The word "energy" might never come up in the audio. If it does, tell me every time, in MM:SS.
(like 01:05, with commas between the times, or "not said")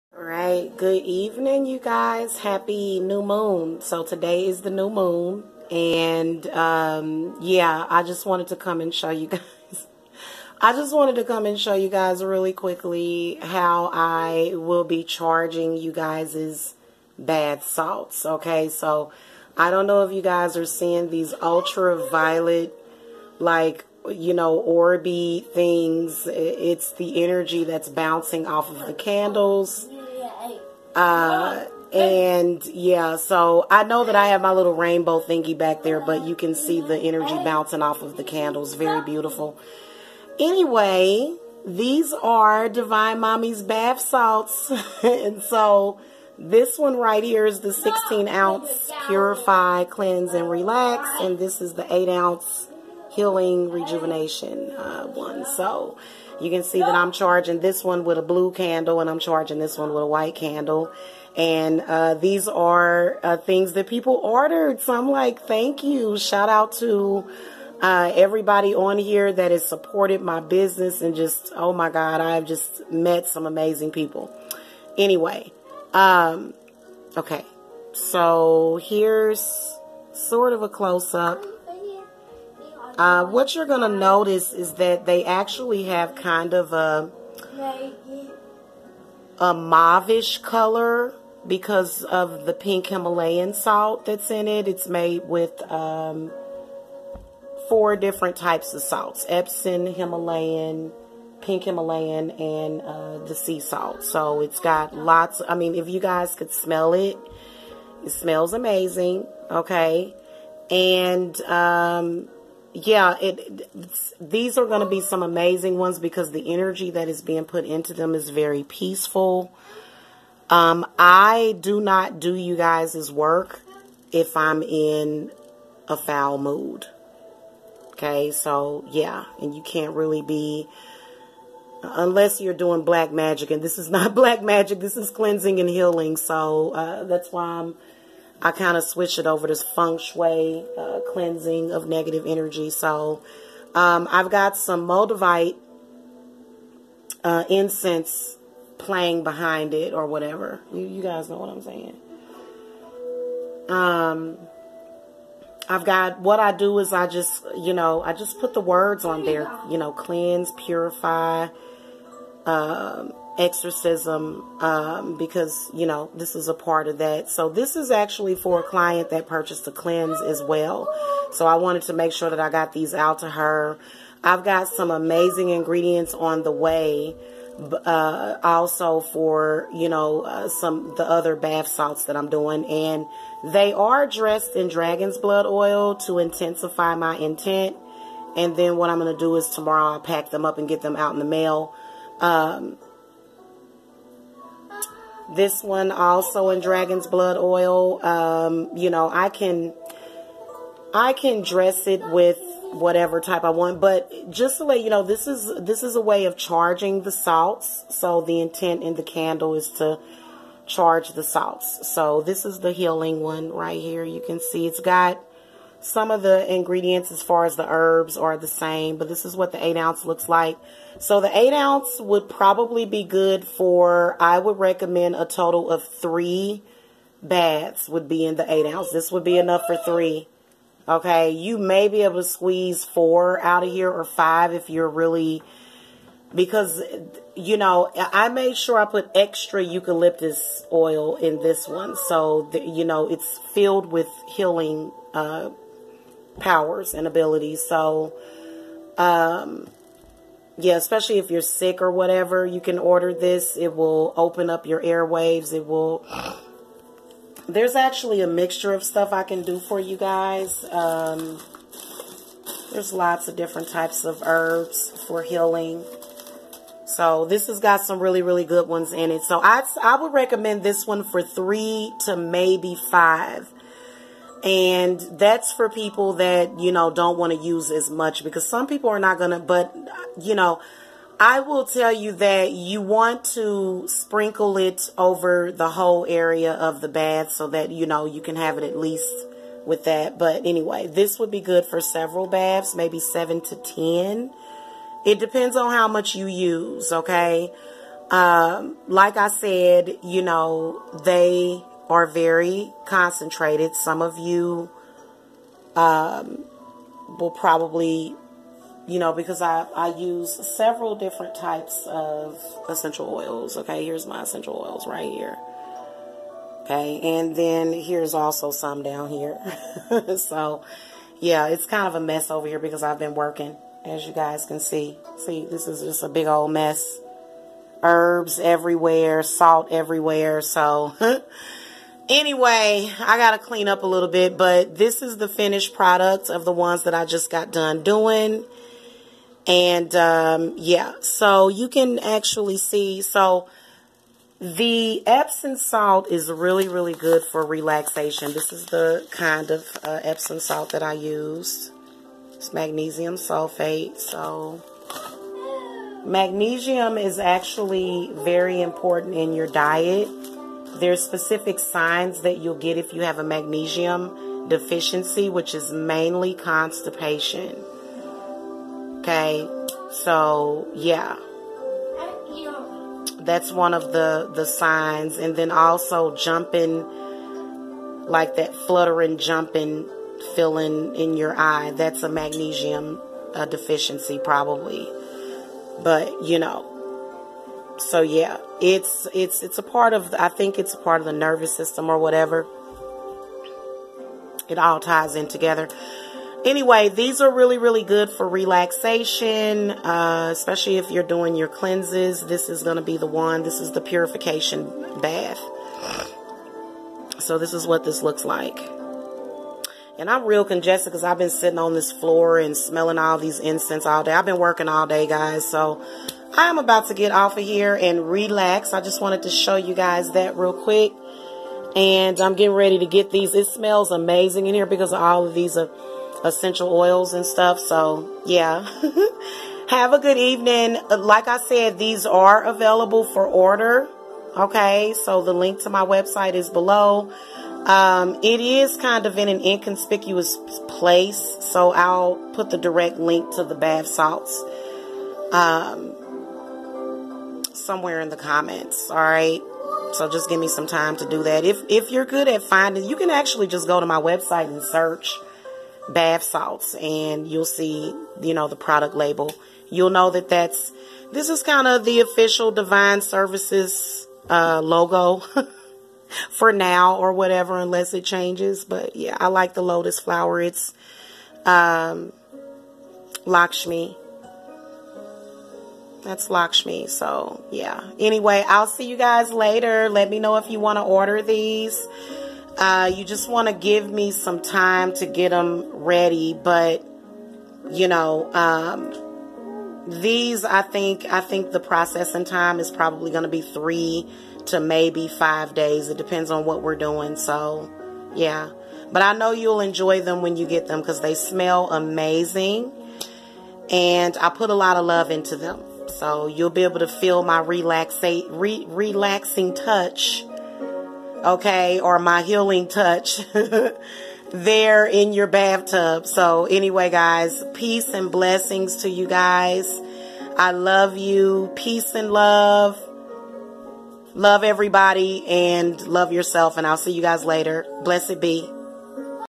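00:27, 00:36, 01:56, 02:22.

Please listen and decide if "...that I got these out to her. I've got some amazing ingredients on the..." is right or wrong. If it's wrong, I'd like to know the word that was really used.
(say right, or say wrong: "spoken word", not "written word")
right.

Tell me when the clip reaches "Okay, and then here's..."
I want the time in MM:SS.
05:16.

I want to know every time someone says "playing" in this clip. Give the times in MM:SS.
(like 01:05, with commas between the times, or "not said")
02:28.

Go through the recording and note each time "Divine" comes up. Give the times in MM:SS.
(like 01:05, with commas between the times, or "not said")
00:42, 07:42.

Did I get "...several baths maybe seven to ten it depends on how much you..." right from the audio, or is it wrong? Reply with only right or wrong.
right.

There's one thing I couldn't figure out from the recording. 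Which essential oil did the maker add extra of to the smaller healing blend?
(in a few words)
Eucalyptus.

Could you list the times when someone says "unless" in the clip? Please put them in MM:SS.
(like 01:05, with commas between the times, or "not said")
02:11, 07:47.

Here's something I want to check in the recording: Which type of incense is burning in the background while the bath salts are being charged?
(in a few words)
Moldavite.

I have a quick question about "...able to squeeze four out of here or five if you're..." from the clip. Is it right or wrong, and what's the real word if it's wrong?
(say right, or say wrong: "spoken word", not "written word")
right.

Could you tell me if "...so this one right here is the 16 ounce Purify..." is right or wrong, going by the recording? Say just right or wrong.
right.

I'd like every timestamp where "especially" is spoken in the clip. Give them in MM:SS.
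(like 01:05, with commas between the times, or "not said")
04:10, 06:40.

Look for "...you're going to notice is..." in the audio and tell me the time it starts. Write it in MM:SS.
01:23.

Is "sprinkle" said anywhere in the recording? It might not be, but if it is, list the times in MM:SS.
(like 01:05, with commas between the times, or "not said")
04:43.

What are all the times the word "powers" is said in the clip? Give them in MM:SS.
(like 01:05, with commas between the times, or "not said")
04:06.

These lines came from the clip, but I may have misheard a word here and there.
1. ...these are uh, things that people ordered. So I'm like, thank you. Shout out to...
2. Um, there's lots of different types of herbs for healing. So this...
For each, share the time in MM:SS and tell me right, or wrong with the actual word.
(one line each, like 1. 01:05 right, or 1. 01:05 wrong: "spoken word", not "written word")
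1. 01:02 right
2. 04:20 right.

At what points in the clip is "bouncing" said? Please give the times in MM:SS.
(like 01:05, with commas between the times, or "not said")
00:27, 00:37.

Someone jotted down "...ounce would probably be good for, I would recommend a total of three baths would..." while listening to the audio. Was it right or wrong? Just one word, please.
right.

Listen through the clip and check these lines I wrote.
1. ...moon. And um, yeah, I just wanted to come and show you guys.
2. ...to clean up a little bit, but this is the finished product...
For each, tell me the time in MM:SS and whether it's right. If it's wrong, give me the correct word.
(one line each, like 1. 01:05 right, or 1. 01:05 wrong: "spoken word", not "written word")
1. 00:04 right
2. 05:33 right.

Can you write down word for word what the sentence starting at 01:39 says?
Epsom, Himalayan, pink Himalayan, and uh, the sea salt.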